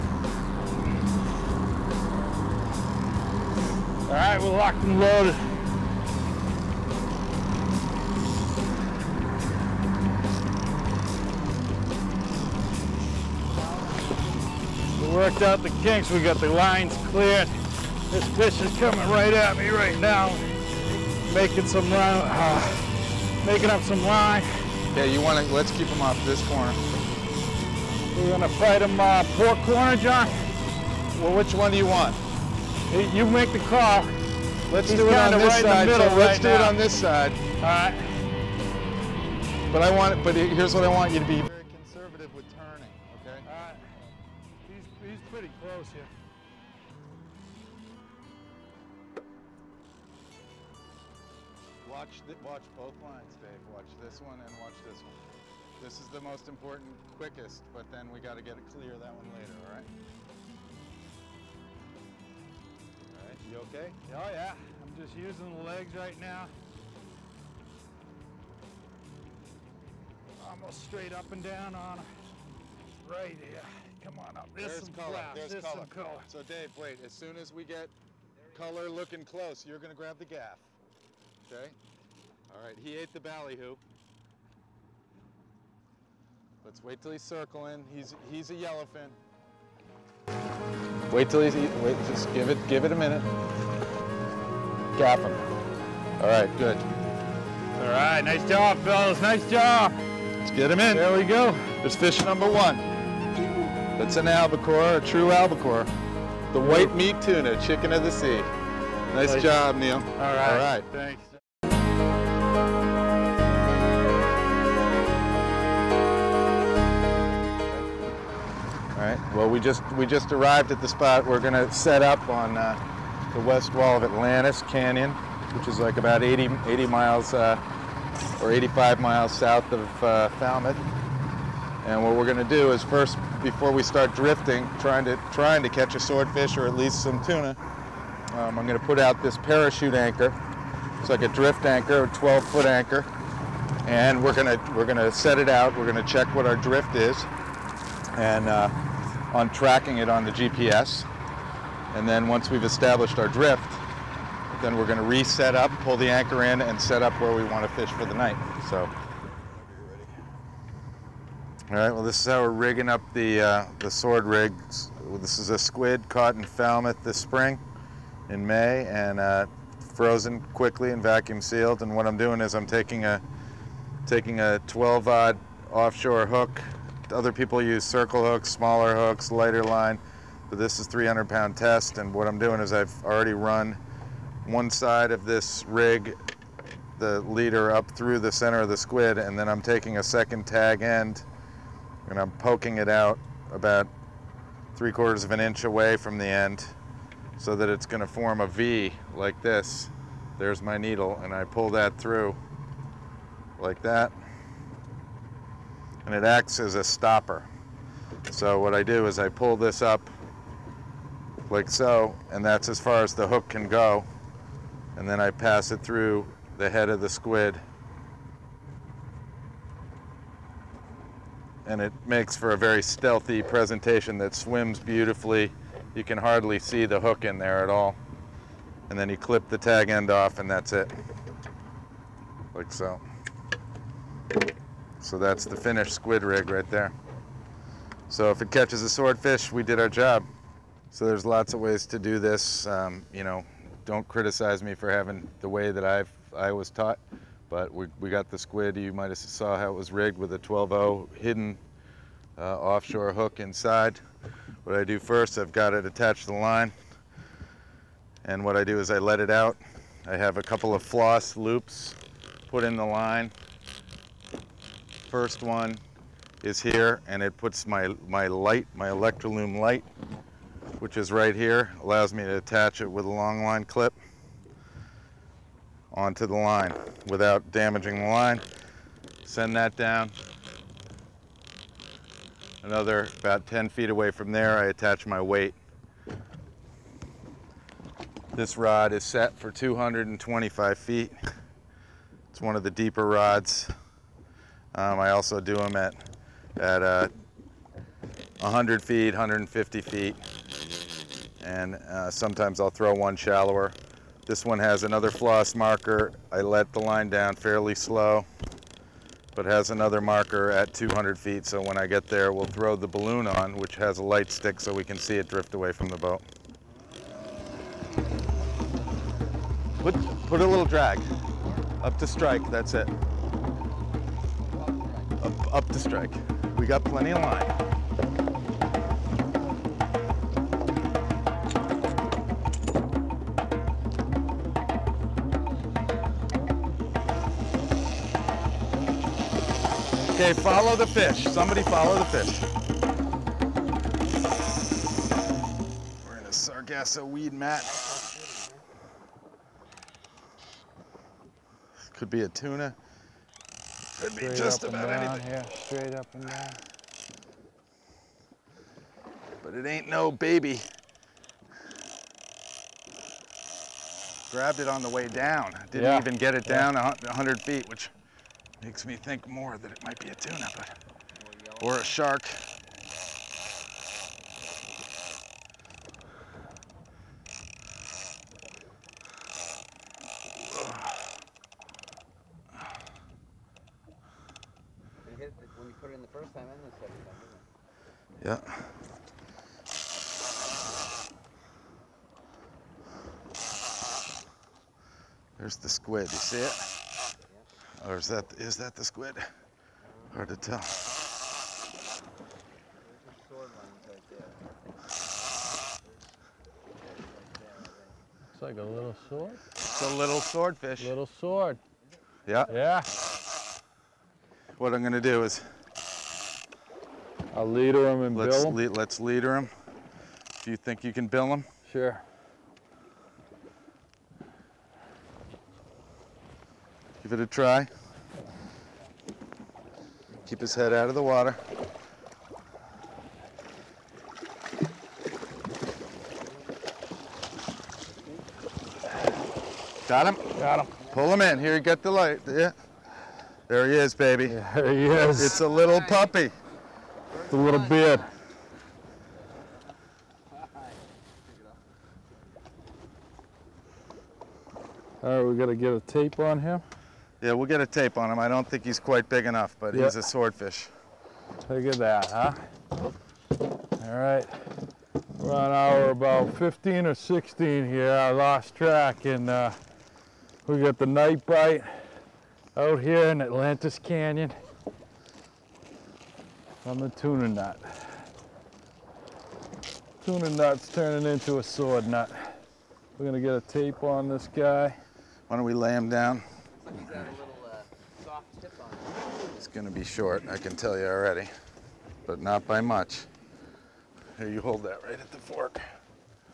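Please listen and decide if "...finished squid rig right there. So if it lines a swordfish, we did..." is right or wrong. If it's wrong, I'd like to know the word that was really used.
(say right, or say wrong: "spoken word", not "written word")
wrong: "catches", not "lines".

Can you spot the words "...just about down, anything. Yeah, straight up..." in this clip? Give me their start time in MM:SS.
05:54.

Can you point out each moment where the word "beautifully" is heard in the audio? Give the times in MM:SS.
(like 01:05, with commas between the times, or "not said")
03:44.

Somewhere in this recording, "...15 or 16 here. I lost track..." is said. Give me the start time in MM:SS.
07:46.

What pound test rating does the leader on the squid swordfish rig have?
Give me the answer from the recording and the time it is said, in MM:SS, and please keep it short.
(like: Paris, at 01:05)
300 pound, at 03:00.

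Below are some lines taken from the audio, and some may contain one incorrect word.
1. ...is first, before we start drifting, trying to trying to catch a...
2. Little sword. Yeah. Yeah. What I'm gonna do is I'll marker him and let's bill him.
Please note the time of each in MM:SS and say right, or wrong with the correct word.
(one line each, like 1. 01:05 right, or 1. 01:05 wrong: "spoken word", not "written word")
1. 02:12 right
2. 06:50 wrong: "leader", not "marker".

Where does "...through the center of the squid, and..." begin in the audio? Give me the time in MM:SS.
03:07.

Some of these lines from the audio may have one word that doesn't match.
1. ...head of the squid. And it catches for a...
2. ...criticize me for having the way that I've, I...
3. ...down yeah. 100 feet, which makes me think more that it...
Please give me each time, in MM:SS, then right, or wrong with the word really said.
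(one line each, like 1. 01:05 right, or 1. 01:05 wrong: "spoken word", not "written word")
1. 03:36 wrong: "makes", not "catches"
2. 04:04 right
3. 06:06 right.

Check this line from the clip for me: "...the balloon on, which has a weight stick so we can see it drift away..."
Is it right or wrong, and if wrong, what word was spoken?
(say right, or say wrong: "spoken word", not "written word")
wrong: "light", not "weight".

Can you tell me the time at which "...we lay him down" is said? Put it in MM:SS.
08:05.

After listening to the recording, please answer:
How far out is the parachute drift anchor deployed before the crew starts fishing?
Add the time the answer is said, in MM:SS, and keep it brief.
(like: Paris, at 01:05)
12 feet, at 02:22.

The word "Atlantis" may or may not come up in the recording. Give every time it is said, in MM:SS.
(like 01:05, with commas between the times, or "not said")
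02:04, 07:53.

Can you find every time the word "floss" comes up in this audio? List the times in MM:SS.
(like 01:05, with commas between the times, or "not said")
04:20, 05:05.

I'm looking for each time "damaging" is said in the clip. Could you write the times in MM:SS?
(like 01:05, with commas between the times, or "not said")
04:37.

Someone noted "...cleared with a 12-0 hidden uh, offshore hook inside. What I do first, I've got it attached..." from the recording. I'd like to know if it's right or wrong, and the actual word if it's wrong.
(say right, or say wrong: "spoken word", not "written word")
wrong: "rigged", not "cleared".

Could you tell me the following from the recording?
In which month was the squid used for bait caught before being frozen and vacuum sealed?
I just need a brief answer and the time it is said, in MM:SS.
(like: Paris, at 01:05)
May, at 02:48.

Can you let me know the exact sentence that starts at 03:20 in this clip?
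There's my needle and I pull that through like that and it acts as a stopper.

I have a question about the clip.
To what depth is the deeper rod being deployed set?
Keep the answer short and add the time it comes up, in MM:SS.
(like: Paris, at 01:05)
225 feet, at 04:49.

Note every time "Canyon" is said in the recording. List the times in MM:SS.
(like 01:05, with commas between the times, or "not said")
02:04, 07:53.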